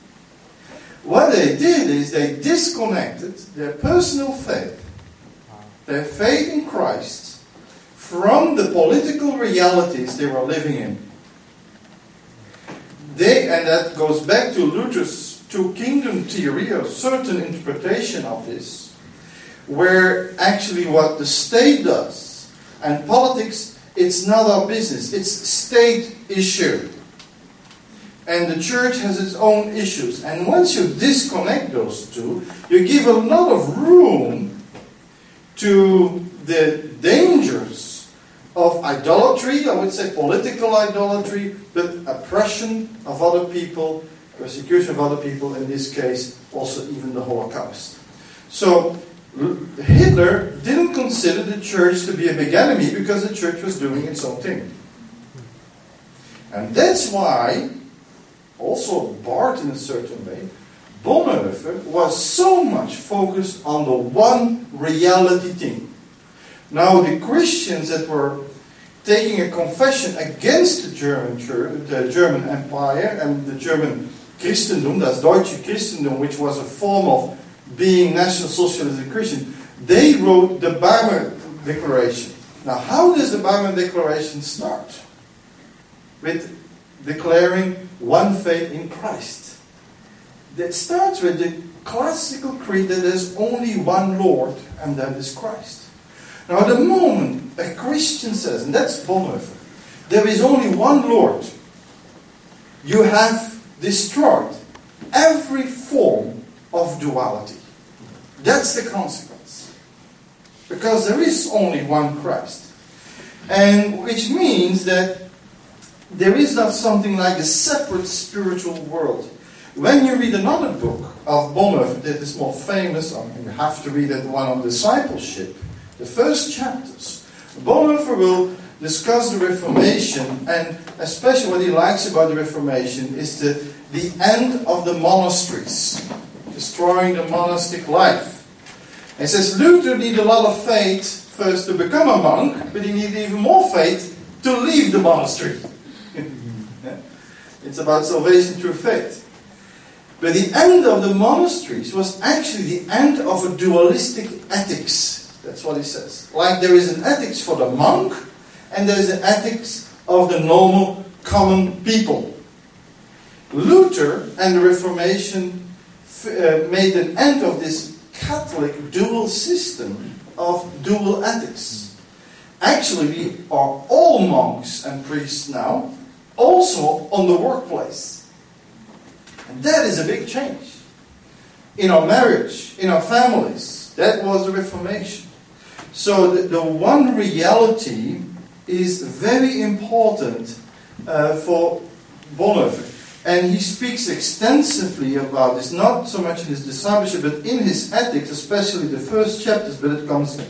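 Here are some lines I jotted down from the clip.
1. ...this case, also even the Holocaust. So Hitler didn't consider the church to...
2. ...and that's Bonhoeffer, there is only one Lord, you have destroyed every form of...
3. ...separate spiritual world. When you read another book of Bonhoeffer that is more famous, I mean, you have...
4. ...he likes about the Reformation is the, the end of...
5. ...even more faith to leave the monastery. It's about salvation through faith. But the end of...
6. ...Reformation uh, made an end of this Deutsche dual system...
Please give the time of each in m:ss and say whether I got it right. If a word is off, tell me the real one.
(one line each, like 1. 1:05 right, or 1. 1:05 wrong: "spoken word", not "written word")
1. 0:45 right
2. 1:38 right
3. 1:57 right
4. 2:11 right
5. 2:23 right
6. 2:44 wrong: "Catholic", not "Deutsche".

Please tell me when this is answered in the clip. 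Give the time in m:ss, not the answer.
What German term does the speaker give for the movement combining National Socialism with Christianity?
1:15.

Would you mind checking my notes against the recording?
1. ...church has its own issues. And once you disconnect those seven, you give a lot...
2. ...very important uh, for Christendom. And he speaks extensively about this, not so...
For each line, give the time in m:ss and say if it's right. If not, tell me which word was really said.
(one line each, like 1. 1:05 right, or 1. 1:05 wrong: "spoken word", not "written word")
1. 0:28 wrong: "two", not "seven"
2. 3:09 wrong: "Bonhoeffer", not "Christendom".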